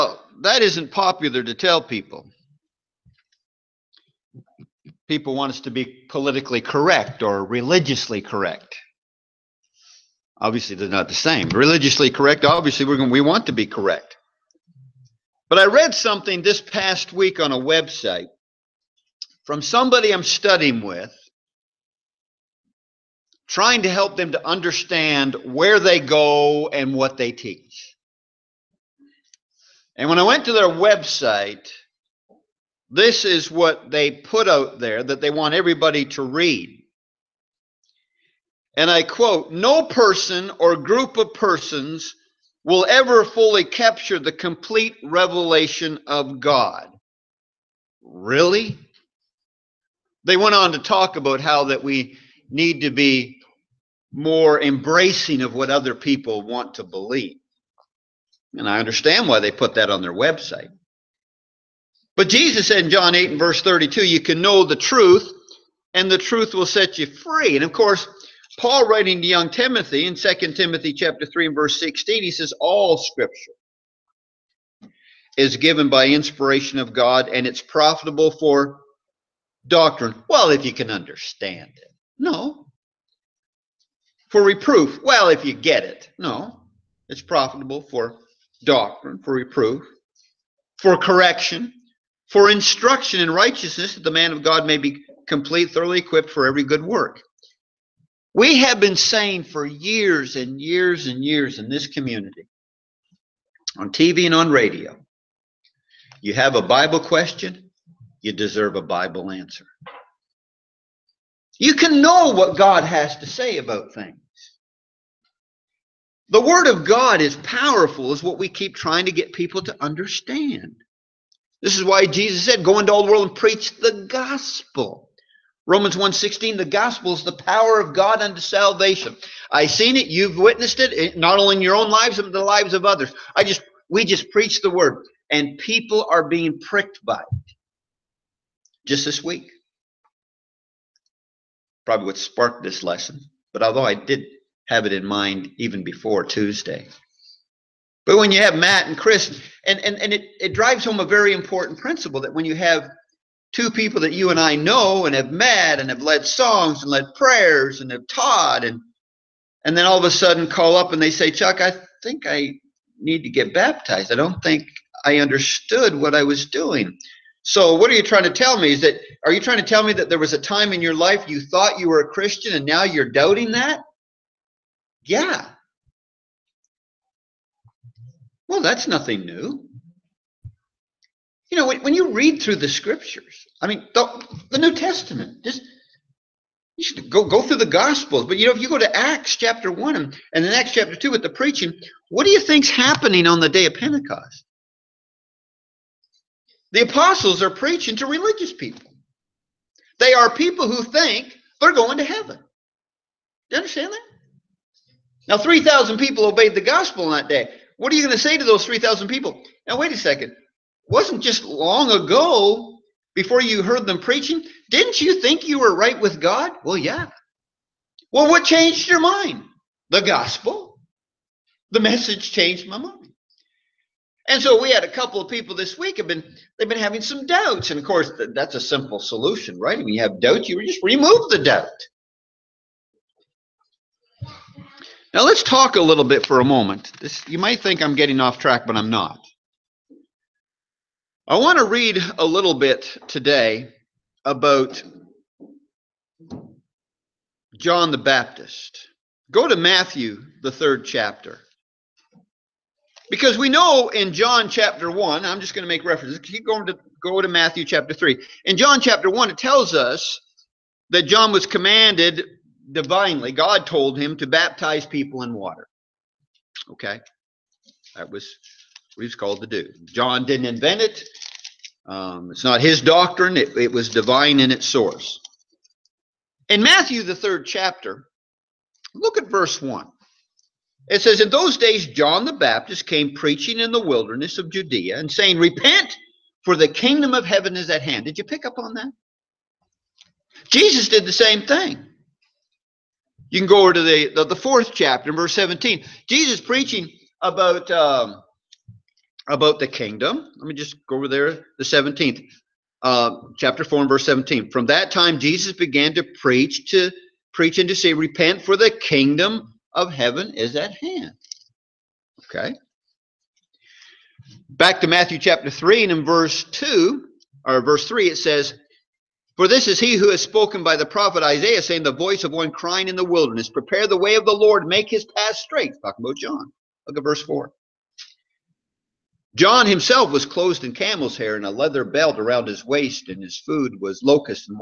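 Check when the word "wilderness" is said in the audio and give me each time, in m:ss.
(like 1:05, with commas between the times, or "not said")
4:43, 5:23.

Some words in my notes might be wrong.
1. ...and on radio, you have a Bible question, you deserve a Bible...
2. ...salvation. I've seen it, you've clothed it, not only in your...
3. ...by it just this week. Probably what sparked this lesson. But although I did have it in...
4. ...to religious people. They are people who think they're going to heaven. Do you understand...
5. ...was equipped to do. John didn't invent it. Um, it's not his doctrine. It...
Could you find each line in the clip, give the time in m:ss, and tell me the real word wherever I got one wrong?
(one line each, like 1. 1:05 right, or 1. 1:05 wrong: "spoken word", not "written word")
1. 1:44 right
2. 2:08 wrong: "witnessed", not "clothed"
3. 2:17 right
4. 3:17 right
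5. 4:29 wrong: "called", not "equipped".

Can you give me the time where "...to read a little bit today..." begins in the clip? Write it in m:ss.
4:01.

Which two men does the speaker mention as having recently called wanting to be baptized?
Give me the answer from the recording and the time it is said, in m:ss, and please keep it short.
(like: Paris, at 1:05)
Matt and Chris, at 2:28.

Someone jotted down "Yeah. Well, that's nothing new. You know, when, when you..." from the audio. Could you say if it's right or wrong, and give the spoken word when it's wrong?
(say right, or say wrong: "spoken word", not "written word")
right.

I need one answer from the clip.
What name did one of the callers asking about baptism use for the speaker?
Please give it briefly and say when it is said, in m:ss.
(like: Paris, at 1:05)
Chuck, at 2:41.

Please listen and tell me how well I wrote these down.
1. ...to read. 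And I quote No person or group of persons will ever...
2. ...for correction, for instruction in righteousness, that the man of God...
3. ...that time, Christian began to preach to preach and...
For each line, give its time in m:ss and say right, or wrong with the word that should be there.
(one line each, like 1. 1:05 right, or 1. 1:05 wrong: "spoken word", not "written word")
1. 0:36 right
2. 1:30 right
3. 5:04 wrong: "Jesus", not "Christian".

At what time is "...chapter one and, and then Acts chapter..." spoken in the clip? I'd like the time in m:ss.
3:09.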